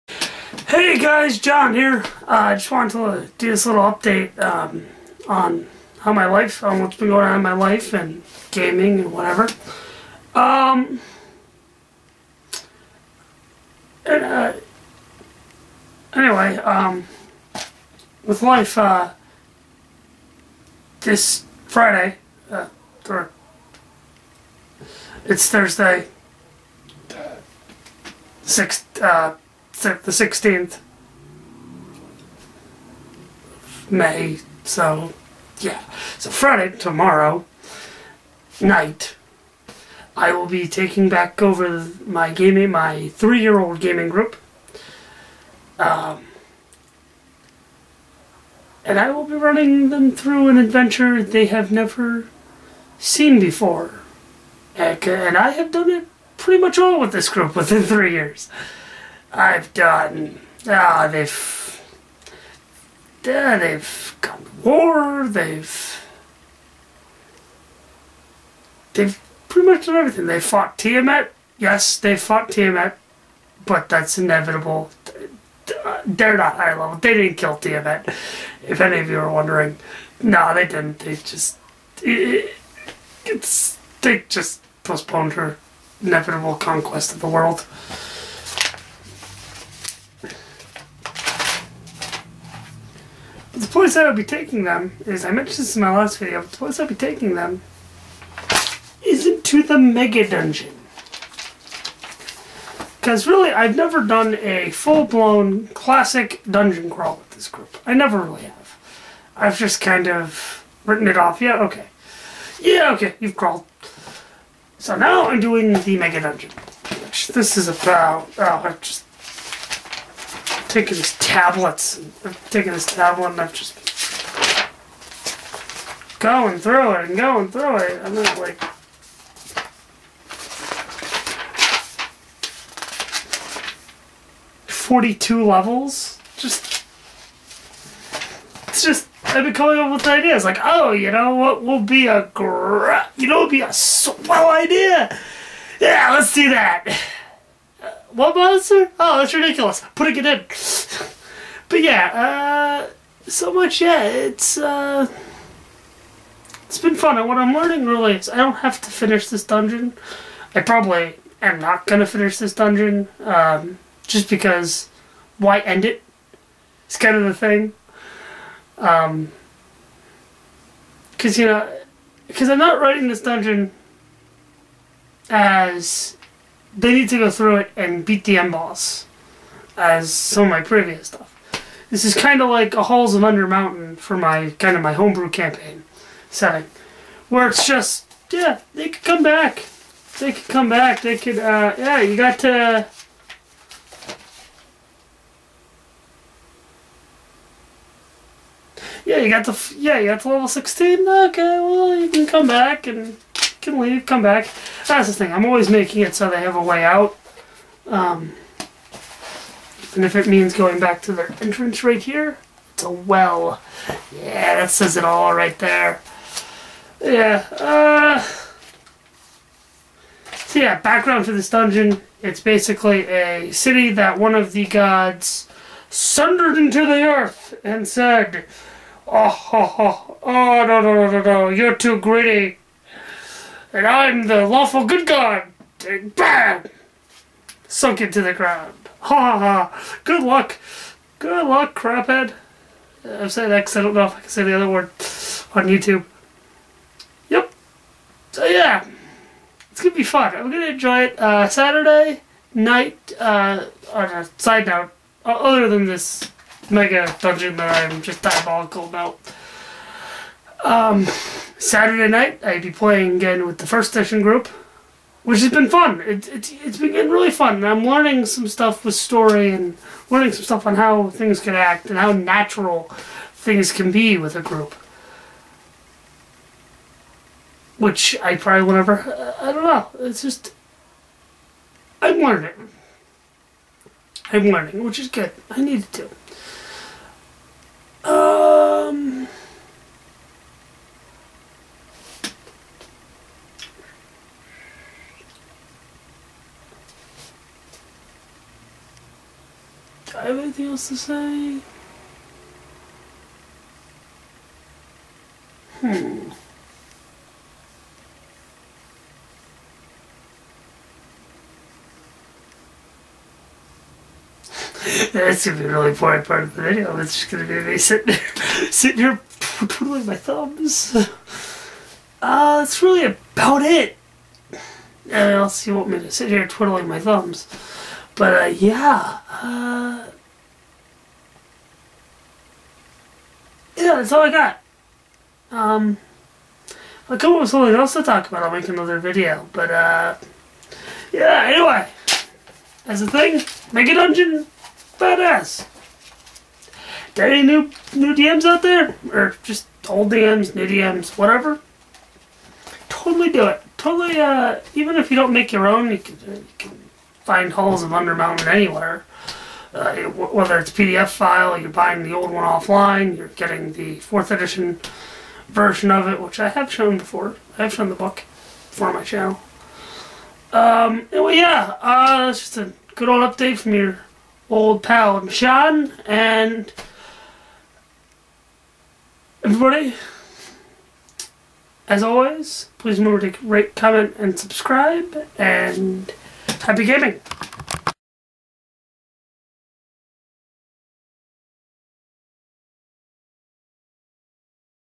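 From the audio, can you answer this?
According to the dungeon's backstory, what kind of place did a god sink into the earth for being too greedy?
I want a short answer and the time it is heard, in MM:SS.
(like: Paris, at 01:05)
A city, at 03:43.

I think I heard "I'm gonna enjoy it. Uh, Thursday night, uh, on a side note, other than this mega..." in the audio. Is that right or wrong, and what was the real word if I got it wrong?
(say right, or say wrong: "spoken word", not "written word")
wrong: "Saturday", not "Thursday".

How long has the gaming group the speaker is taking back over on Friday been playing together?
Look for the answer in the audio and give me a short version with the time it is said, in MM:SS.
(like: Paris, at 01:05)
3 years, at 00:43.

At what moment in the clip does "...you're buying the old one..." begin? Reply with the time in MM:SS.
06:01.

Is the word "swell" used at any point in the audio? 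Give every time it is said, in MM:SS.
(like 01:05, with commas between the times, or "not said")
02:23.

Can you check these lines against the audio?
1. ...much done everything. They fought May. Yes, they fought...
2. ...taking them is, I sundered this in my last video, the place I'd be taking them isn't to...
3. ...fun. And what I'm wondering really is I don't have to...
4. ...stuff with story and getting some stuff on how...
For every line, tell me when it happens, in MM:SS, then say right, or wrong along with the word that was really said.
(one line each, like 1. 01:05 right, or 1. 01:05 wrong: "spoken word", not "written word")
1. 01:09 wrong: "Tiamat", not "May"
2. 01:34 wrong: "mentioned", not "sundered"
3. 02:36 wrong: "learning", not "wondering"
4. 04:28 wrong: "learning", not "getting".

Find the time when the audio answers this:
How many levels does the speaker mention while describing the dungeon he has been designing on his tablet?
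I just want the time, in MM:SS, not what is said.
02:14.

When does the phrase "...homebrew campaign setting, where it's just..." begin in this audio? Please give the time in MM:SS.
03:04.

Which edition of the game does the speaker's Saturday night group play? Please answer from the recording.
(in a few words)
First edition.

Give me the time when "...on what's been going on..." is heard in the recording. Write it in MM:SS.
00:06.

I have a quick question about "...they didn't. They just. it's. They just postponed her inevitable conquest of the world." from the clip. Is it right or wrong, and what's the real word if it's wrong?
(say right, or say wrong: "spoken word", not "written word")
right.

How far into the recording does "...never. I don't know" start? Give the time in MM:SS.
04:38.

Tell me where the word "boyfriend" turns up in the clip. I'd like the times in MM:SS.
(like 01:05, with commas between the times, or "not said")
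not said.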